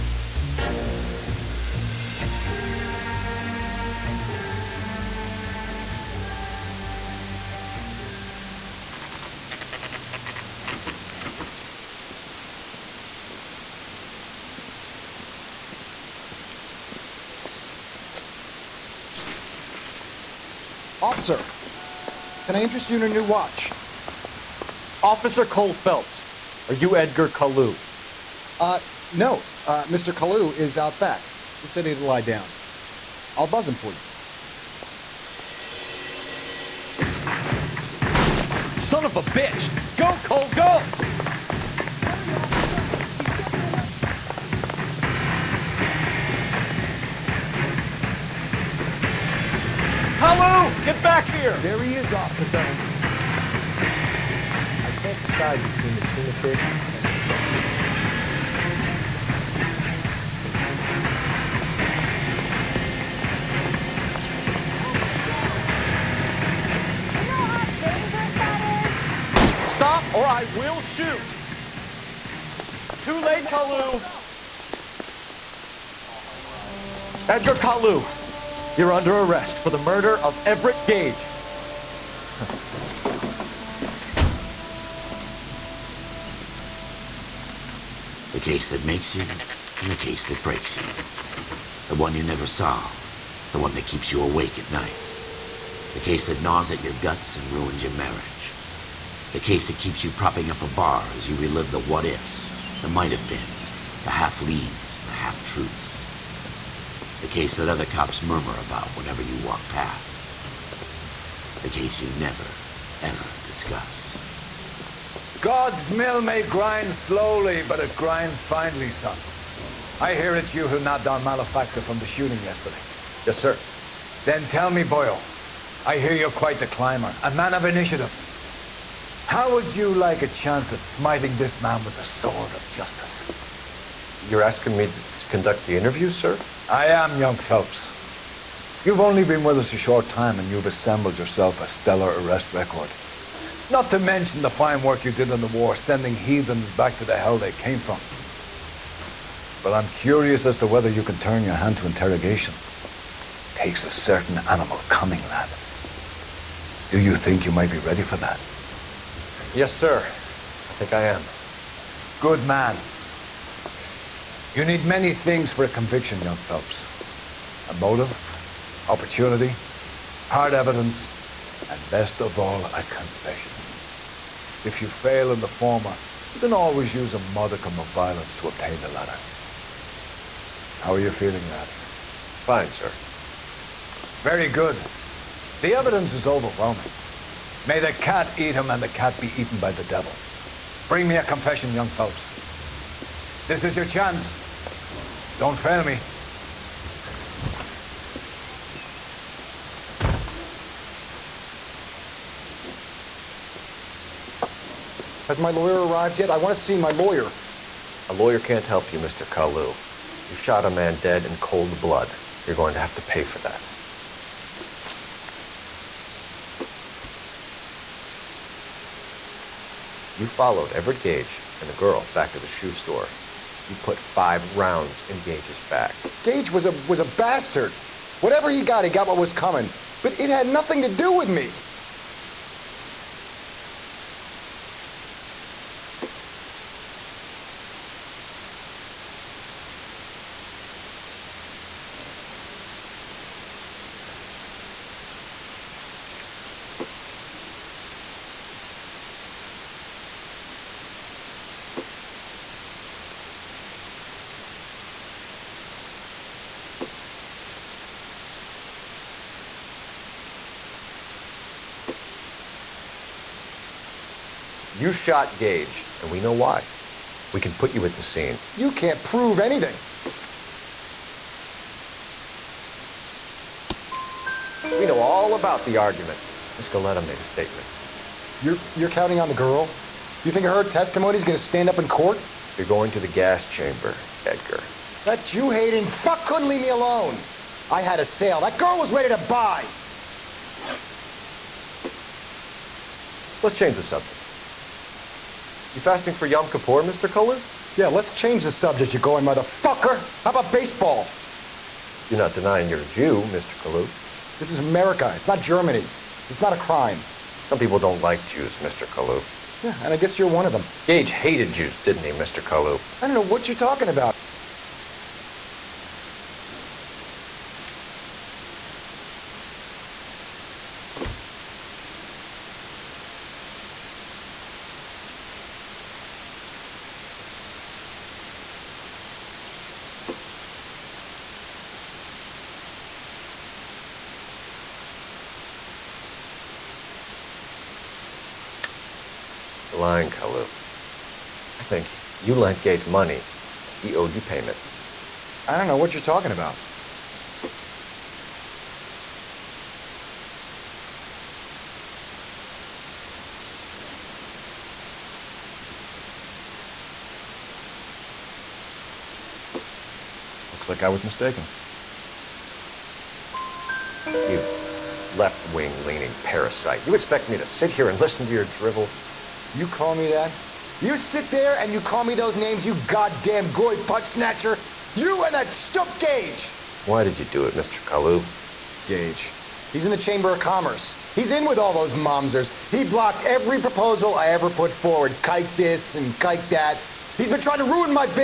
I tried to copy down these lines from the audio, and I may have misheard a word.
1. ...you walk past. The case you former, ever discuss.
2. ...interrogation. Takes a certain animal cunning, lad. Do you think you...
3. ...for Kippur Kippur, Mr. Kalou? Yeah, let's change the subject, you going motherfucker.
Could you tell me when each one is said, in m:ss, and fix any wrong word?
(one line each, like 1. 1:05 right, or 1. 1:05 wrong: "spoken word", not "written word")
1. 1:49 wrong: "never", not "former"
2. 2:31 right
3. 4:56 wrong: "Yom", not "Kippur".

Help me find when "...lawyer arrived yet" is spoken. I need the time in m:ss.
3:25.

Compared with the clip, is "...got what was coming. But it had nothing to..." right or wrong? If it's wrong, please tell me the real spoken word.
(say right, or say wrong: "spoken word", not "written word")
right.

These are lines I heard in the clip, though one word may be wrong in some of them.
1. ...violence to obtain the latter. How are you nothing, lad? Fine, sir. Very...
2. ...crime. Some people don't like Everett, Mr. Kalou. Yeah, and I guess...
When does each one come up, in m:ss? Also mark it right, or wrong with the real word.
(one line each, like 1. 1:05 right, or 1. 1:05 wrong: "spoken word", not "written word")
1. 2:57 wrong: "feeling", not "nothing"
2. 5:06 wrong: "Jews", not "Everett".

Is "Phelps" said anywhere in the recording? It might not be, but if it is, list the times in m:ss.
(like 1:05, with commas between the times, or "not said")
0:25, 2:17, 2:46, 3:11.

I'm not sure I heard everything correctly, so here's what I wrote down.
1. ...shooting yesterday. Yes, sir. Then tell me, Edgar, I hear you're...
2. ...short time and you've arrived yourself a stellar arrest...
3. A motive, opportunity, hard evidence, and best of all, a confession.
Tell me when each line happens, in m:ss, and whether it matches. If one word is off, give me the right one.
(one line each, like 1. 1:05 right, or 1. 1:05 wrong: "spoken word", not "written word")
1. 2:02 wrong: "Boyle", not "Edgar"
2. 2:19 wrong: "assembled", not "arrived"
3. 2:47 right.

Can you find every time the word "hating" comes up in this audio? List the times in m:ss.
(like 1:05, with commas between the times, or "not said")
4:45.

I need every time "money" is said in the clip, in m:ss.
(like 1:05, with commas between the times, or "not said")
5:42.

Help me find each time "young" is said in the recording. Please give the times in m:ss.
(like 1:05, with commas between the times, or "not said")
2:17, 2:46, 3:11.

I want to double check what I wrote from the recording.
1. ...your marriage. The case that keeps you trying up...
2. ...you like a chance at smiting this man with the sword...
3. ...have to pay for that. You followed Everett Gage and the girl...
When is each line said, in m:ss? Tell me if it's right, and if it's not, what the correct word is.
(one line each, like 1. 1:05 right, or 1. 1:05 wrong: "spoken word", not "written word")
1. 1:37 wrong: "propping", not "trying"
2. 2:09 right
3. 3:32 right.